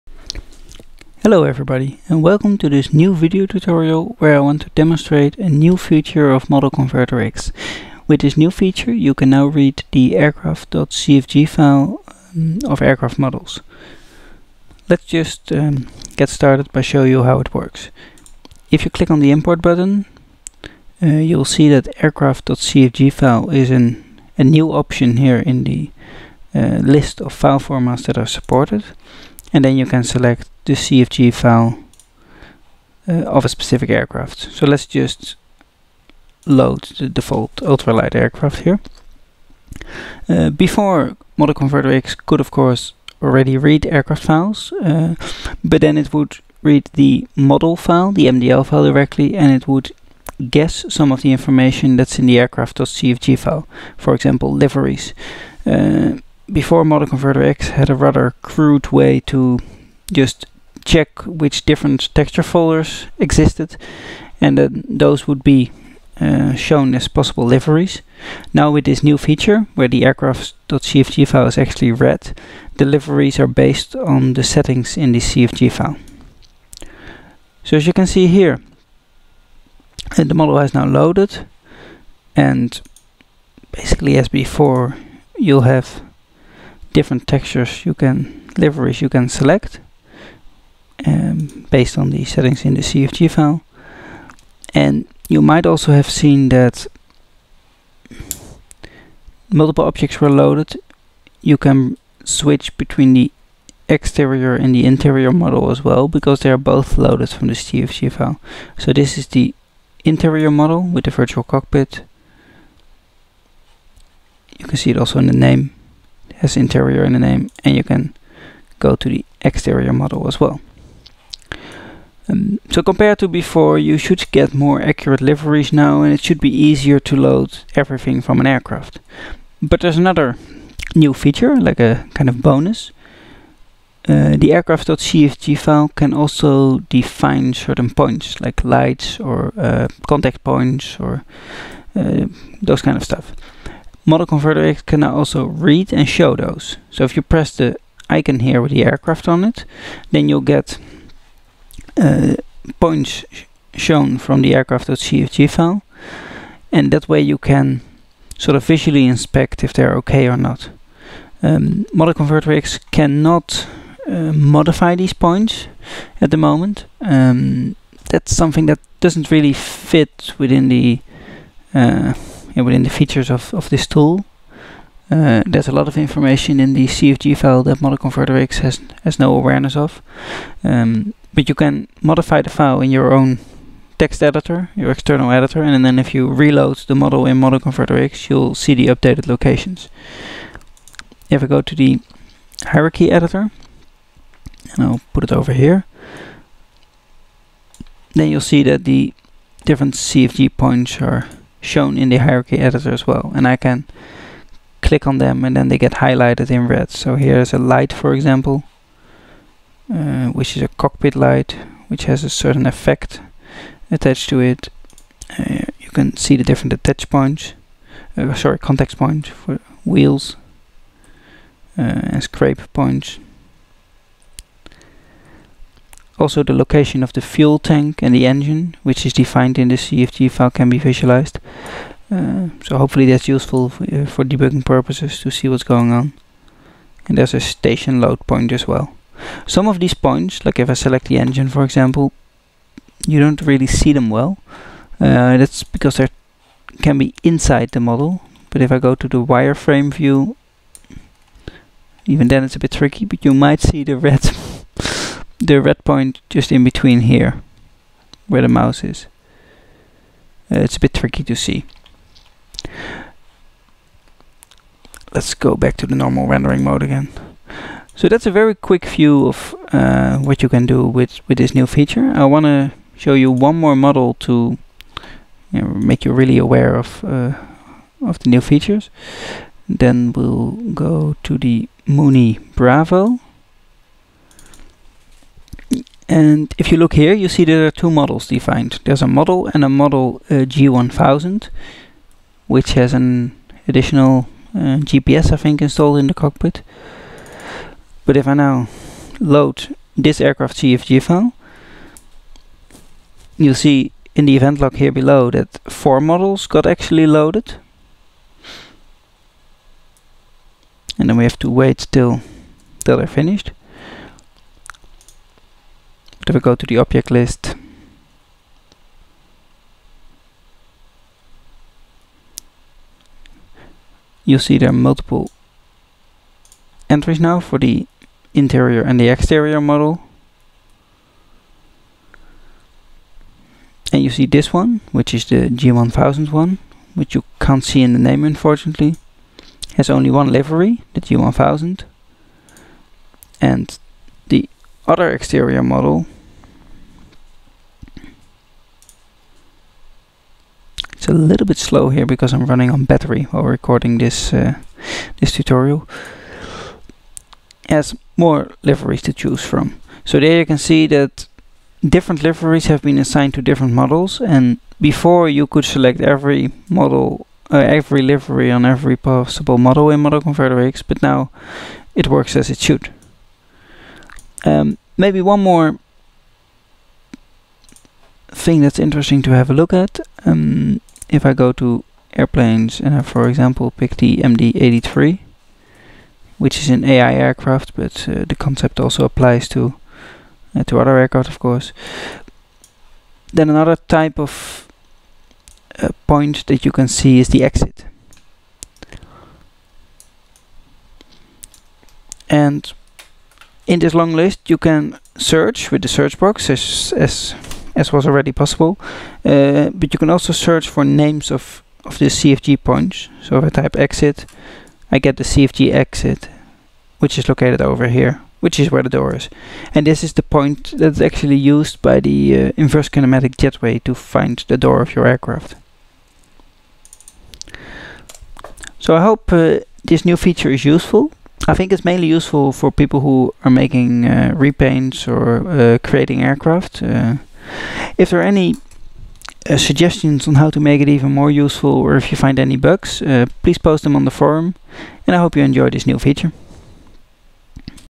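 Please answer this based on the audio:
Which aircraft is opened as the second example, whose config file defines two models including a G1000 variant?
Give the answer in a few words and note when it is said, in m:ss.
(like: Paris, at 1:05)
Mooney Bravo, at 4:41.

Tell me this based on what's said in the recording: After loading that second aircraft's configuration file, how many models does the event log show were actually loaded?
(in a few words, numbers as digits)
4.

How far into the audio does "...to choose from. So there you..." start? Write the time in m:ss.
5:59.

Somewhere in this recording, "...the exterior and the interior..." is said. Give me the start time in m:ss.
1:43.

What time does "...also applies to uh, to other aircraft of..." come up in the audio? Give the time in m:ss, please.
6:28.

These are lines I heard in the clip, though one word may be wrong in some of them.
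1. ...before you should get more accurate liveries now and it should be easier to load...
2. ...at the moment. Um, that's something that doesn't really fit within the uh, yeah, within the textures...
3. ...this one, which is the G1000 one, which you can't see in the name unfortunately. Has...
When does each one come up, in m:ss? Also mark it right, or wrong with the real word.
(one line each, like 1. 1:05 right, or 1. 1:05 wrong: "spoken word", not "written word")
1. 2:03 right
2. 2:46 wrong: "features", not "textures"
3. 5:34 right.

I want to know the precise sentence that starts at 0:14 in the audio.
Let's just um, get started by showing you how it works.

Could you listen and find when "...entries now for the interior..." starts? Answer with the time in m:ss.
5:26.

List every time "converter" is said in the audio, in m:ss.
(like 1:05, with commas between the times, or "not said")
0:06, 0:41, 0:57, 2:24, 2:42, 2:57, 3:07, 6:10.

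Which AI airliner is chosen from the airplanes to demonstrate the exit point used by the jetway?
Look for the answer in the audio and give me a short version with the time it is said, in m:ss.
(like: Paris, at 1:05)
MD-83, at 6:24.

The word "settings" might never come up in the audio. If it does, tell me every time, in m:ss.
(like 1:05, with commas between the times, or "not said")
1:14, 1:32.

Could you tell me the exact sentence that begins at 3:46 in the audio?
Also the location of the fuel tank and the engine, which is defined in the CFG file can be visualized.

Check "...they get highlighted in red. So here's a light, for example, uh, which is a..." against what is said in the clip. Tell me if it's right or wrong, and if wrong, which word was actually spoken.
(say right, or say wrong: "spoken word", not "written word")
right.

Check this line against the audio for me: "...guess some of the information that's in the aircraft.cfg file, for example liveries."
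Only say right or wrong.
right.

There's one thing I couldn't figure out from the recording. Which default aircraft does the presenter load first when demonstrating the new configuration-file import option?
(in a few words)
Ultralight aircraft.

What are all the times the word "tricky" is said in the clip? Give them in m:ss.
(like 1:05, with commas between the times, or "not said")
4:12, 4:20.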